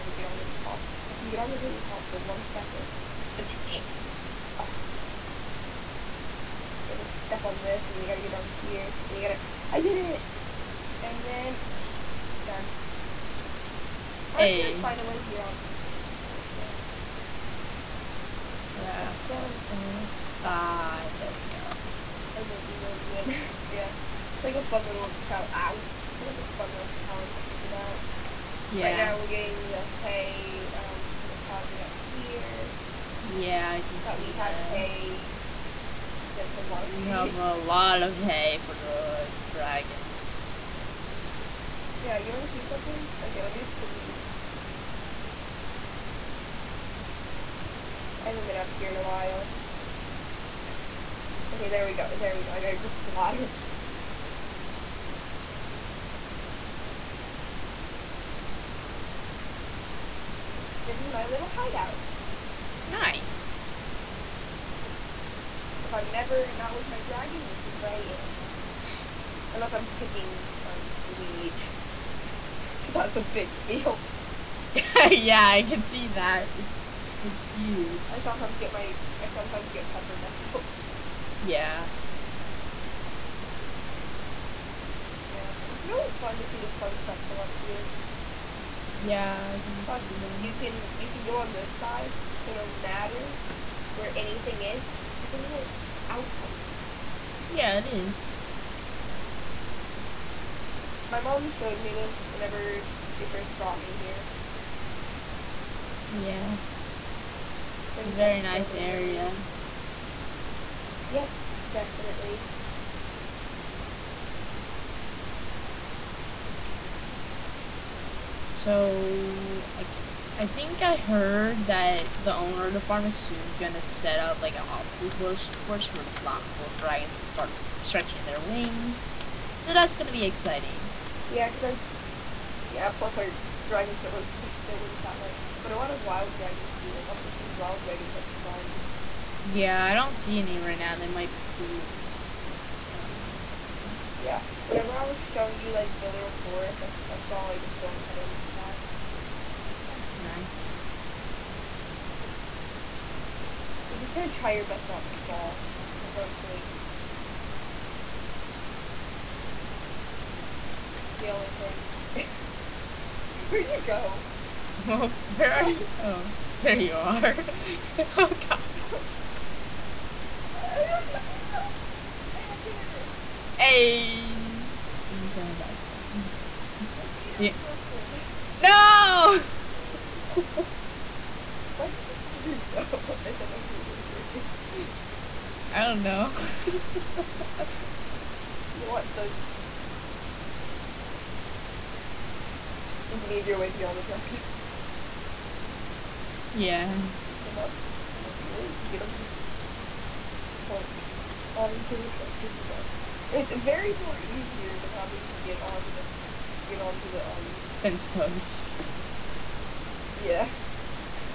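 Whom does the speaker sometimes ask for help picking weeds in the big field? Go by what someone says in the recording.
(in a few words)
Pepper.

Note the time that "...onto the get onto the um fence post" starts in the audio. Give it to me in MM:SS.
03:25.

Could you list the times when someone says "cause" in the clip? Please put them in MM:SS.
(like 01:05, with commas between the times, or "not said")
02:11.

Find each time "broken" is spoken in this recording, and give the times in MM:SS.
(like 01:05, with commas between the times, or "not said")
02:57, 03:04.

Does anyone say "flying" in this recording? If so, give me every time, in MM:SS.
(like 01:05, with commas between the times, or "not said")
02:18.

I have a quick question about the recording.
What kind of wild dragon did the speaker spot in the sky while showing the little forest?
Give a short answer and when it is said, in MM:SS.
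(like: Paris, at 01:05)
Storm cutter, at 02:27.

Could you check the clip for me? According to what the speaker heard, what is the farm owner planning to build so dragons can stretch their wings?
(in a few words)
An obstacle course.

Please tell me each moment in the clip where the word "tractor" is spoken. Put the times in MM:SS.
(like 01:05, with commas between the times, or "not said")
03:14, 03:22.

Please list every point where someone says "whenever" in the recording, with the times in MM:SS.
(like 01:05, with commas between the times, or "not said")
01:42, 02:24.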